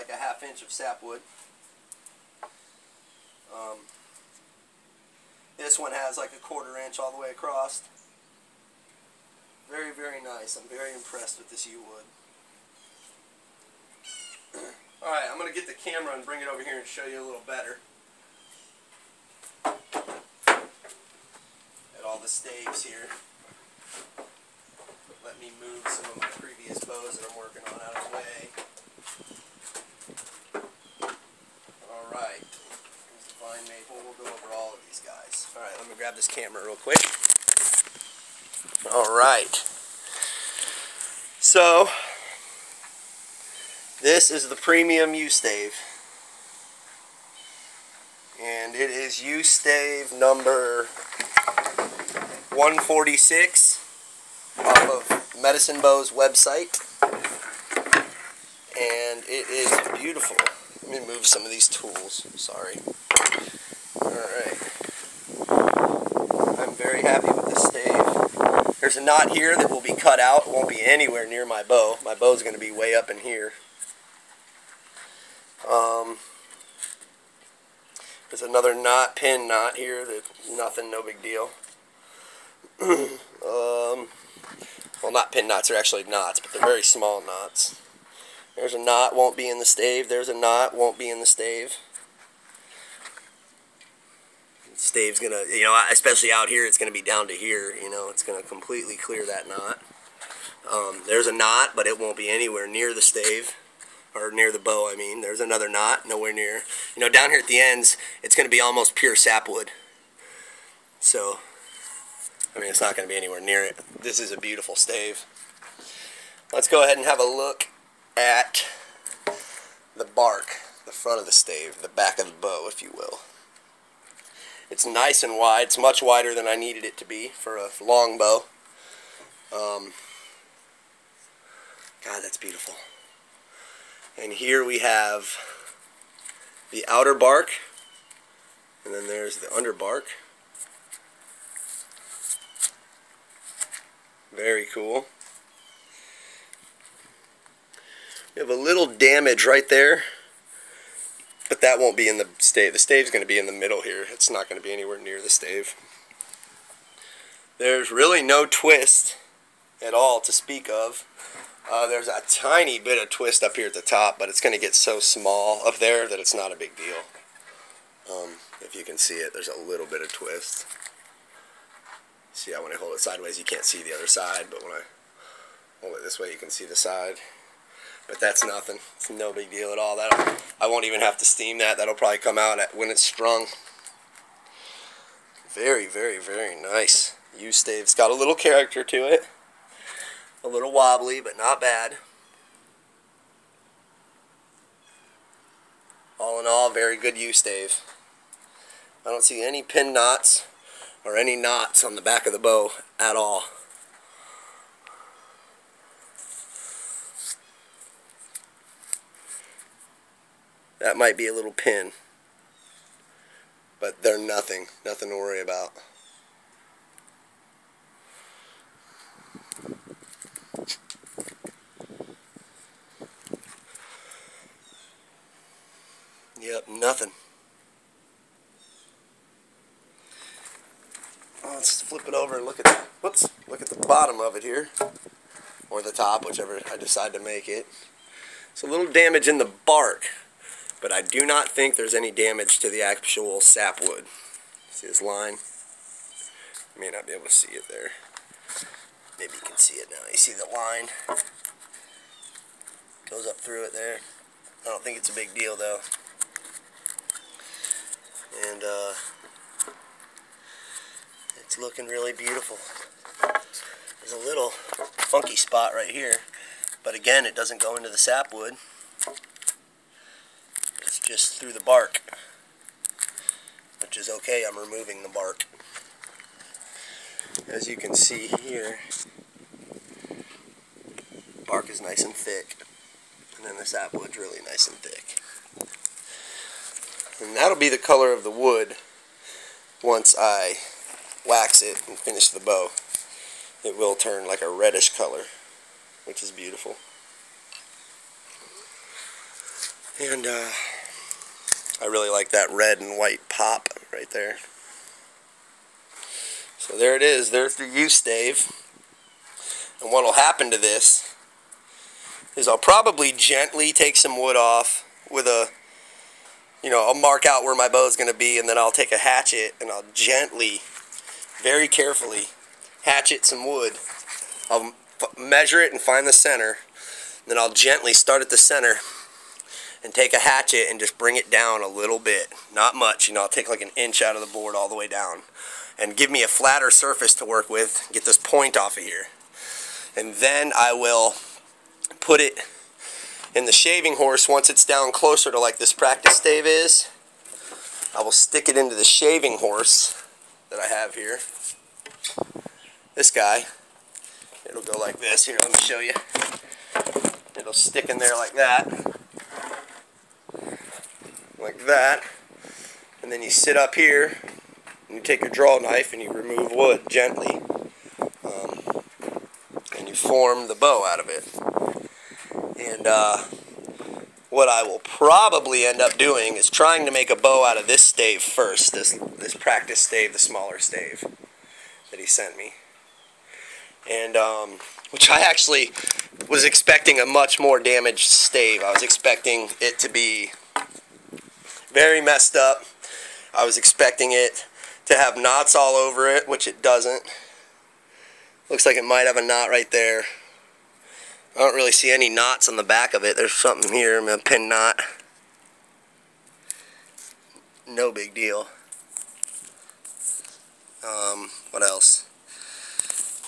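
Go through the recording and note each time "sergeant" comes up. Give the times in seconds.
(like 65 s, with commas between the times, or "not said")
not said.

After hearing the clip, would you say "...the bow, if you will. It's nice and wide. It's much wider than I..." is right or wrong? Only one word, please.
right.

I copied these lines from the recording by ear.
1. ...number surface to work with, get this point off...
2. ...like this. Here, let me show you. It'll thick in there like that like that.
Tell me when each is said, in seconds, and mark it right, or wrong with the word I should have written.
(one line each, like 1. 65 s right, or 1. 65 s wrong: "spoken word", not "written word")
1. 336 s wrong: "flatter", not "number"
2. 354 s wrong: "stick", not "thick".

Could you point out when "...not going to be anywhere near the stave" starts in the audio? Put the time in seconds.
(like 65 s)
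154 s.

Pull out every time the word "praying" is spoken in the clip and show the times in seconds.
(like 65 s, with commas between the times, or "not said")
not said.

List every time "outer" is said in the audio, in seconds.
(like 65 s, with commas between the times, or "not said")
136 s.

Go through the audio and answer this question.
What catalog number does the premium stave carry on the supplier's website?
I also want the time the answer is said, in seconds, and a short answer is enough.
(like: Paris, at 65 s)
146, at 52 s.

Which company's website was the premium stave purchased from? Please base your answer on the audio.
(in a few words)
Medicine Bow.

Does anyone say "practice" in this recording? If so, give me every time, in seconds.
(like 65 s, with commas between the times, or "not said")
345 s, 379 s.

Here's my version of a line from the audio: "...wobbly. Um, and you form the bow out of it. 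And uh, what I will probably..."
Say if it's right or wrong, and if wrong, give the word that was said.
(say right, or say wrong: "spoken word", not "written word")
wrong: "gently", not "wobbly".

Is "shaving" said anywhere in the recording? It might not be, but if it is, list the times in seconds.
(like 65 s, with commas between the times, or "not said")
343 s, 348 s.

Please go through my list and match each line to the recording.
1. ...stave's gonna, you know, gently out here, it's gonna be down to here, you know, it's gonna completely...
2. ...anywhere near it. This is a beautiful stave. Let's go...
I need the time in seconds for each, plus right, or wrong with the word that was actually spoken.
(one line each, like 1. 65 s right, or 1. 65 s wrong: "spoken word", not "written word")
1. 94 s wrong: "especially", not "gently"
2. 113 s right.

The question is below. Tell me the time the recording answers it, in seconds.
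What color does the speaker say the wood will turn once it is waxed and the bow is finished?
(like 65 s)
294 s.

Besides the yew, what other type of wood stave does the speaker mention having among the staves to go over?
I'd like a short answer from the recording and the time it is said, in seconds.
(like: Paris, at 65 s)
vine maple, at 33 s.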